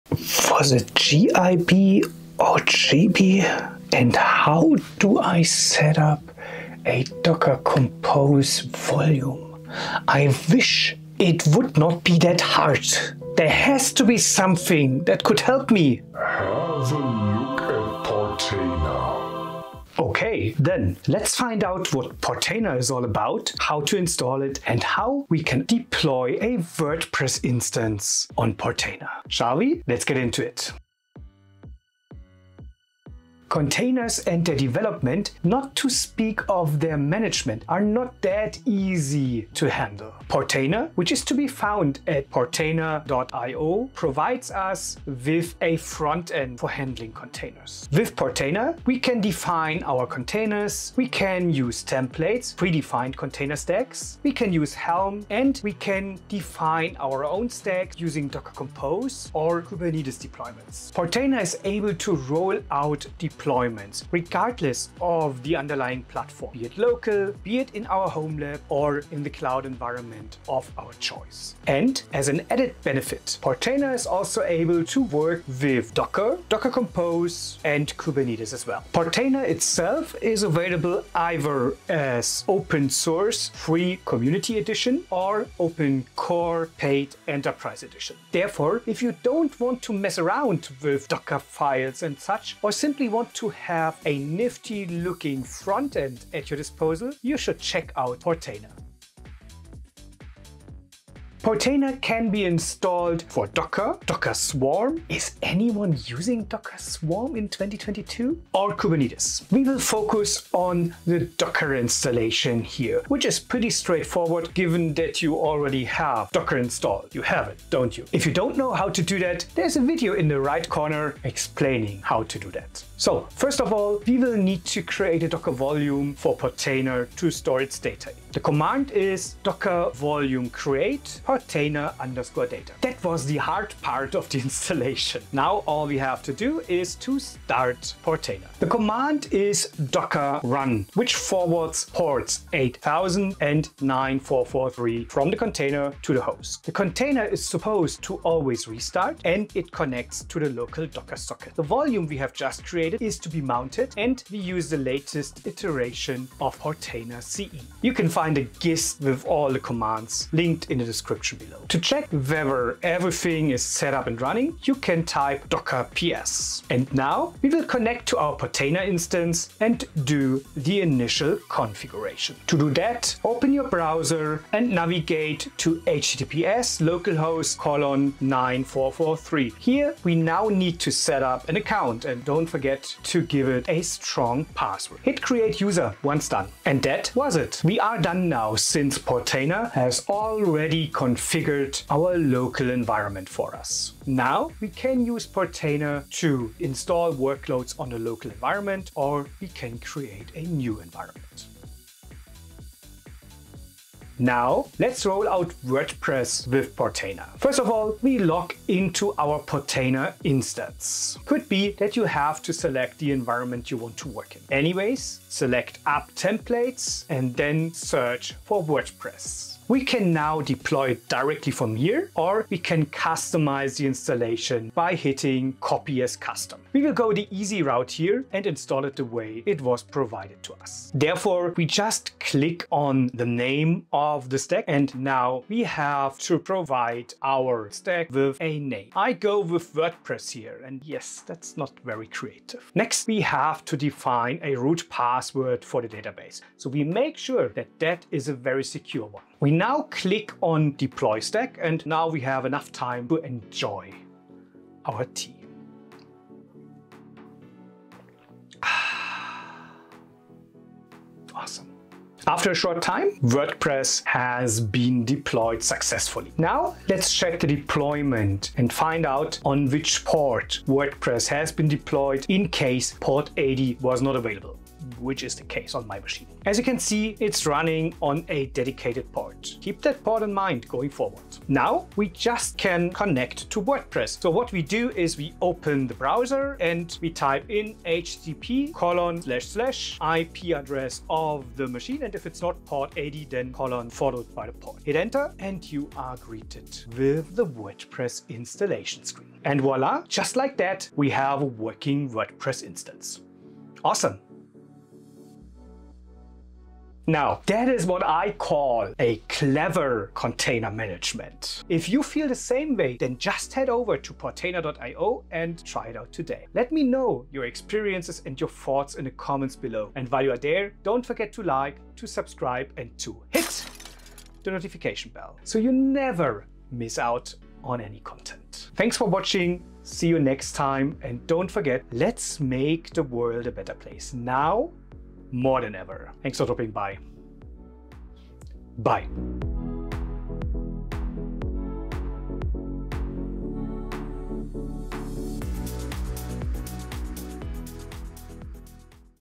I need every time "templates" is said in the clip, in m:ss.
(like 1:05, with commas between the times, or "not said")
0:51, 3:36.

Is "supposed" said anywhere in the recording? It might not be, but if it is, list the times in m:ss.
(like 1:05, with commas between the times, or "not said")
2:27.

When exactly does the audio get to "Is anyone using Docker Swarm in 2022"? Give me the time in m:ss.
1:45.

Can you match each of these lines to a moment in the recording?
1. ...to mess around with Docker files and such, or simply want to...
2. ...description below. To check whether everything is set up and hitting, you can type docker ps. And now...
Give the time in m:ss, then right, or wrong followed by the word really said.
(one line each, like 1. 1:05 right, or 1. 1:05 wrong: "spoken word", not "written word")
1. 1:29 right
2. 2:40 wrong: "running", not "hitting".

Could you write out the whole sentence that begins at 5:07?
Now, that is what I call a clever container management.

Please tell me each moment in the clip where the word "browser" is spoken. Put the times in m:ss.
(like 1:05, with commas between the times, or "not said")
2:53, 4:45.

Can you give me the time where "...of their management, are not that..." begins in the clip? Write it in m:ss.
0:36.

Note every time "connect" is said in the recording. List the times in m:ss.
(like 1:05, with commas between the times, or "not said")
2:29, 2:47, 4:42.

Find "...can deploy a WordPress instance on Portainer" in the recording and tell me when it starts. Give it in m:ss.
0:25.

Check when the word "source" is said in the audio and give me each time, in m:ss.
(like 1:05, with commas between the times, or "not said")
1:22.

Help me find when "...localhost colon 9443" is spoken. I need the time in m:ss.
2:56.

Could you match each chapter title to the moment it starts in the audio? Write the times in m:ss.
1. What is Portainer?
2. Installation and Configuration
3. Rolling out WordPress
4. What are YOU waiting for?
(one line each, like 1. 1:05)
1. 0:31
2. 1:40
3. 3:22
4. 5:05.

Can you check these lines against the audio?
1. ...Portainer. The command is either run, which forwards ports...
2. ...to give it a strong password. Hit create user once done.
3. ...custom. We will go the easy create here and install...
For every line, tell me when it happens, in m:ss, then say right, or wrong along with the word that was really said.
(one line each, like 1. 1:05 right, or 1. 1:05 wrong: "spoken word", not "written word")
1. 2:18 wrong: "docker", not "either"
2. 3:03 right
3. 3:46 wrong: "route", not "create".